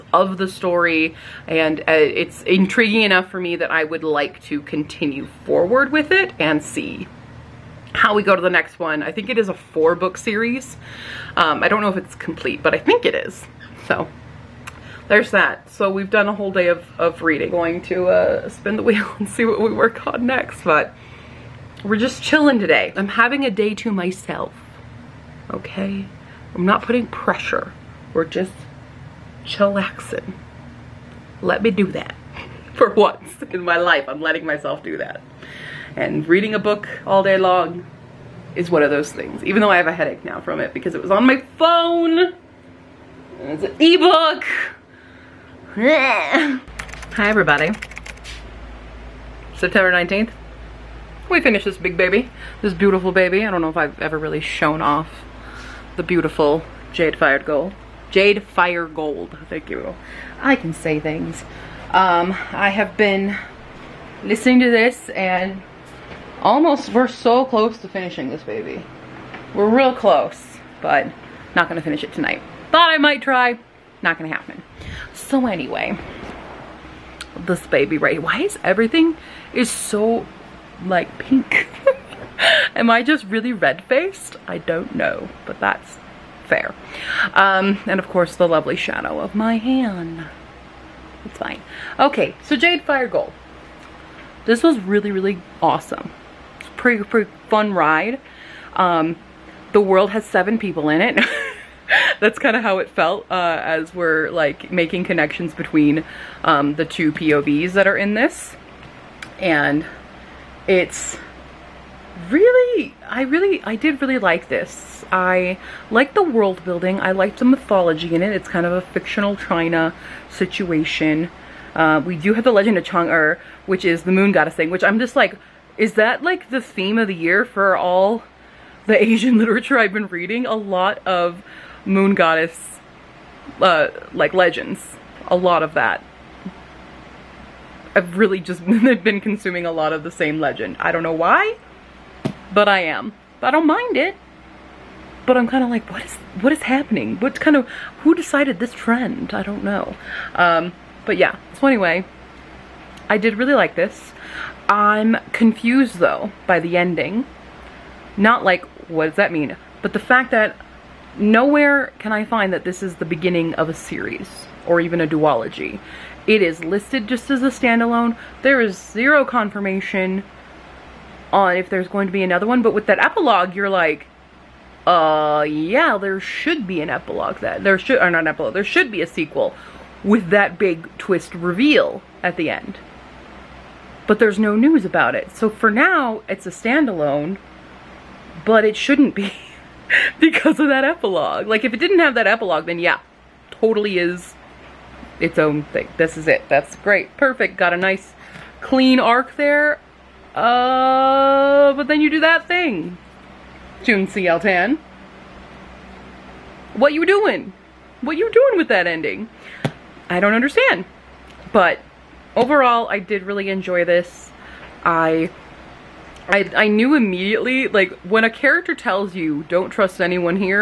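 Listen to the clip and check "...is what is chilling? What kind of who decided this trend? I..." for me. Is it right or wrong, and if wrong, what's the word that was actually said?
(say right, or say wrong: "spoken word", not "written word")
wrong: "happening", not "chilling".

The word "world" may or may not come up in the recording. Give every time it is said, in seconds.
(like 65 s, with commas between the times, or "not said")
99 s, 116 s.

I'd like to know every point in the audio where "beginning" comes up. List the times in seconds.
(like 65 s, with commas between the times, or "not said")
163 s.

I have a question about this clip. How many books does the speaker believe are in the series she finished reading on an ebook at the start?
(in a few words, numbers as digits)
4.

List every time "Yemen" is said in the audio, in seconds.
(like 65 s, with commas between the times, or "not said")
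not said.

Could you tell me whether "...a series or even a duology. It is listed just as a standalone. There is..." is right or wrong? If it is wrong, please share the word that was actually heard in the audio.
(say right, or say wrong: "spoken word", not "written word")
right.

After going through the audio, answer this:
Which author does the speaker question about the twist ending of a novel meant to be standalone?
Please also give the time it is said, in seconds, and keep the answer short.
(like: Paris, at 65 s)
June C.L. Tan, at 203 s.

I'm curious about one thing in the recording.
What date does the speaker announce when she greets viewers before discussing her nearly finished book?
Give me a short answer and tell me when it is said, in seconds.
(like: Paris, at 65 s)
September 19th, at 49 s.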